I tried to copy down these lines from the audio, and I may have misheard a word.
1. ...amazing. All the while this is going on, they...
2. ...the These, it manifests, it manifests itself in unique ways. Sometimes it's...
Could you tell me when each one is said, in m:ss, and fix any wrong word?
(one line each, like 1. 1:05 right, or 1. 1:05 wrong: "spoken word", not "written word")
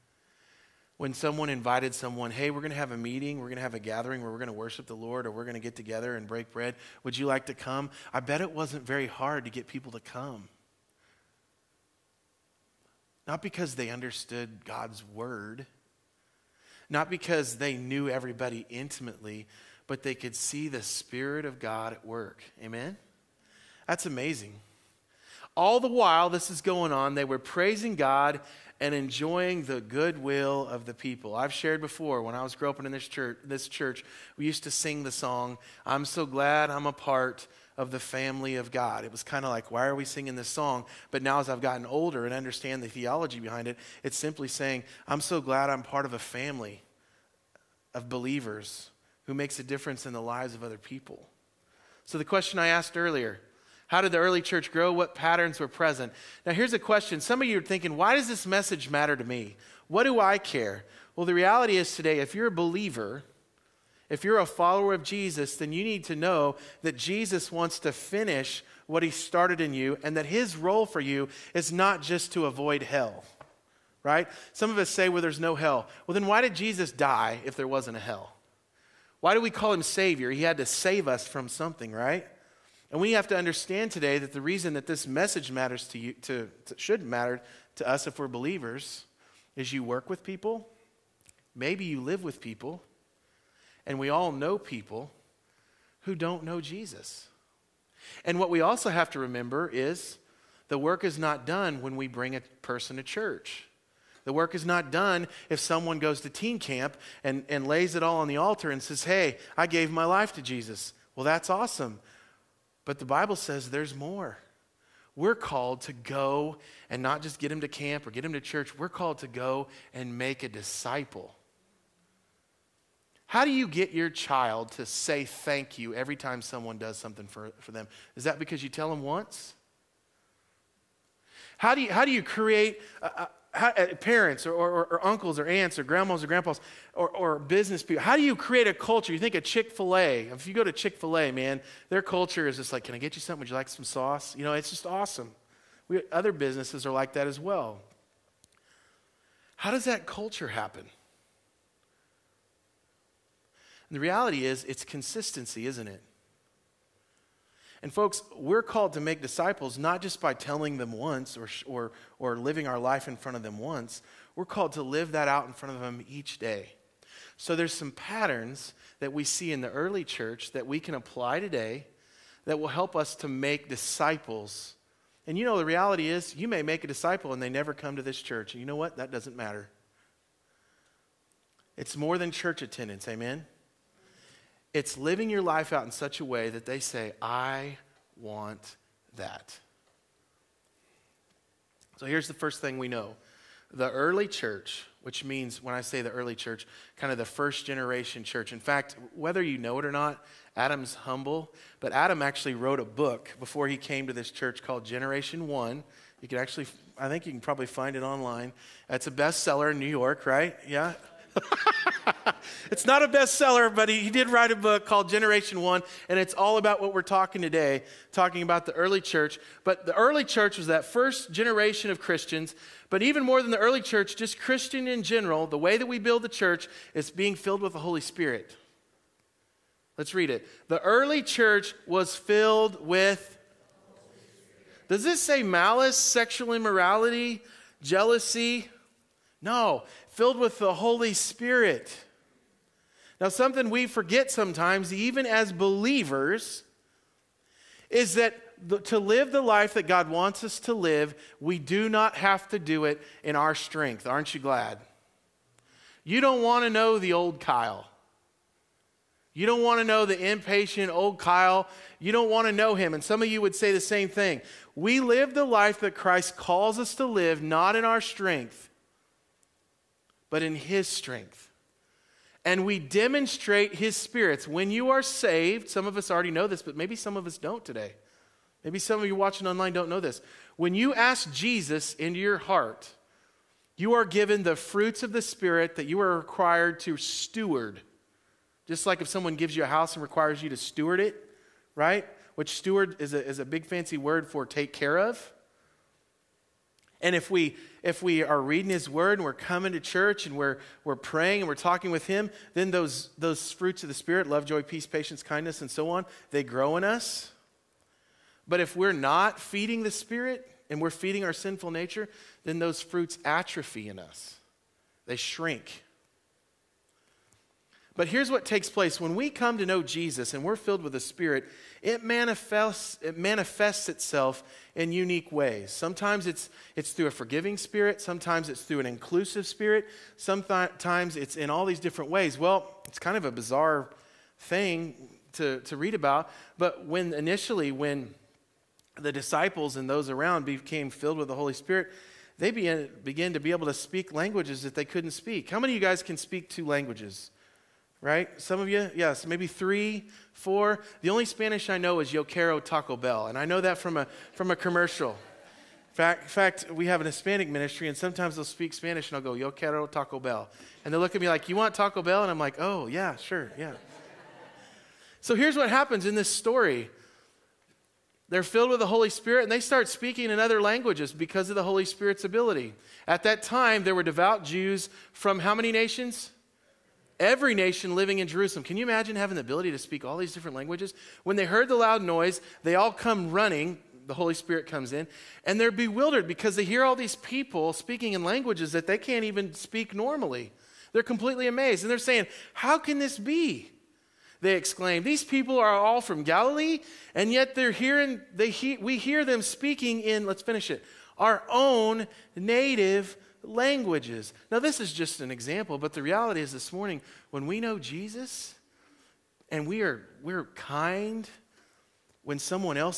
1. 0:24 right
2. 5:20 wrong: "Spirit", not "These".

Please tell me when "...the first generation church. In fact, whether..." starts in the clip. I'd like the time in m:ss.
3:17.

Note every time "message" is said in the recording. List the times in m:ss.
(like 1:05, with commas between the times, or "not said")
0:58, 1:25.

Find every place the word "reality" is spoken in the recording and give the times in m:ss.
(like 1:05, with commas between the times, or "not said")
1:01, 2:33, 2:55, 6:46.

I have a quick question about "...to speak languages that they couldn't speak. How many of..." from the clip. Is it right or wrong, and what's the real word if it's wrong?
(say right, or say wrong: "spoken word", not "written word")
right.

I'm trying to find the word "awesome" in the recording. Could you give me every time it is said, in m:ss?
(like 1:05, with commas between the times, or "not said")
1:51, 2:24.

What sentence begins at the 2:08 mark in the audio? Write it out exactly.
Is that because you tell them once?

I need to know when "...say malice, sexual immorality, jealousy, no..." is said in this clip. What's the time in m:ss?
3:55.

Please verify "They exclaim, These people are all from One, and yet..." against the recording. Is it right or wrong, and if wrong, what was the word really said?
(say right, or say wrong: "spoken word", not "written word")
wrong: "Galilee", not "One".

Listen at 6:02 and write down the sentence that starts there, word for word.
And I'm like, Oh, yeah, sure, yeah.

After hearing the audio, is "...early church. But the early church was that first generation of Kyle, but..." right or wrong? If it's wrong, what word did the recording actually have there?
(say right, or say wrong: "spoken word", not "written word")
wrong: "Christians", not "Kyle".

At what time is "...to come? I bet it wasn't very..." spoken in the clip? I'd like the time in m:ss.
0:07.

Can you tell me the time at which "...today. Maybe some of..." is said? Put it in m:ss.
4:37.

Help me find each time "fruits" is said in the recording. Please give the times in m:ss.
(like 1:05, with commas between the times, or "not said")
4:44, 5:03, 5:12.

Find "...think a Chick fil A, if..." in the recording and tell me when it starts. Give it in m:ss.
2:19.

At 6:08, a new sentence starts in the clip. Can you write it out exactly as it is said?
They're filled with the Holy Spirit and they start speaking in other languages because of the Holy Spirit's ability.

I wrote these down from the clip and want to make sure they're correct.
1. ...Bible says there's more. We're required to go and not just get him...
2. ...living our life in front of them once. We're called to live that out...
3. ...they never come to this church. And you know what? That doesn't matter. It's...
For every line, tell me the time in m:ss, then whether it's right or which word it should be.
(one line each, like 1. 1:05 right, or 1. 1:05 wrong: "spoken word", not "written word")
1. 1:53 wrong: "called", not "required"
2. 2:42 right
3. 2:57 right.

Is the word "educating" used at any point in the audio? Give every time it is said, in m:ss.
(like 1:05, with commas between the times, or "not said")
not said.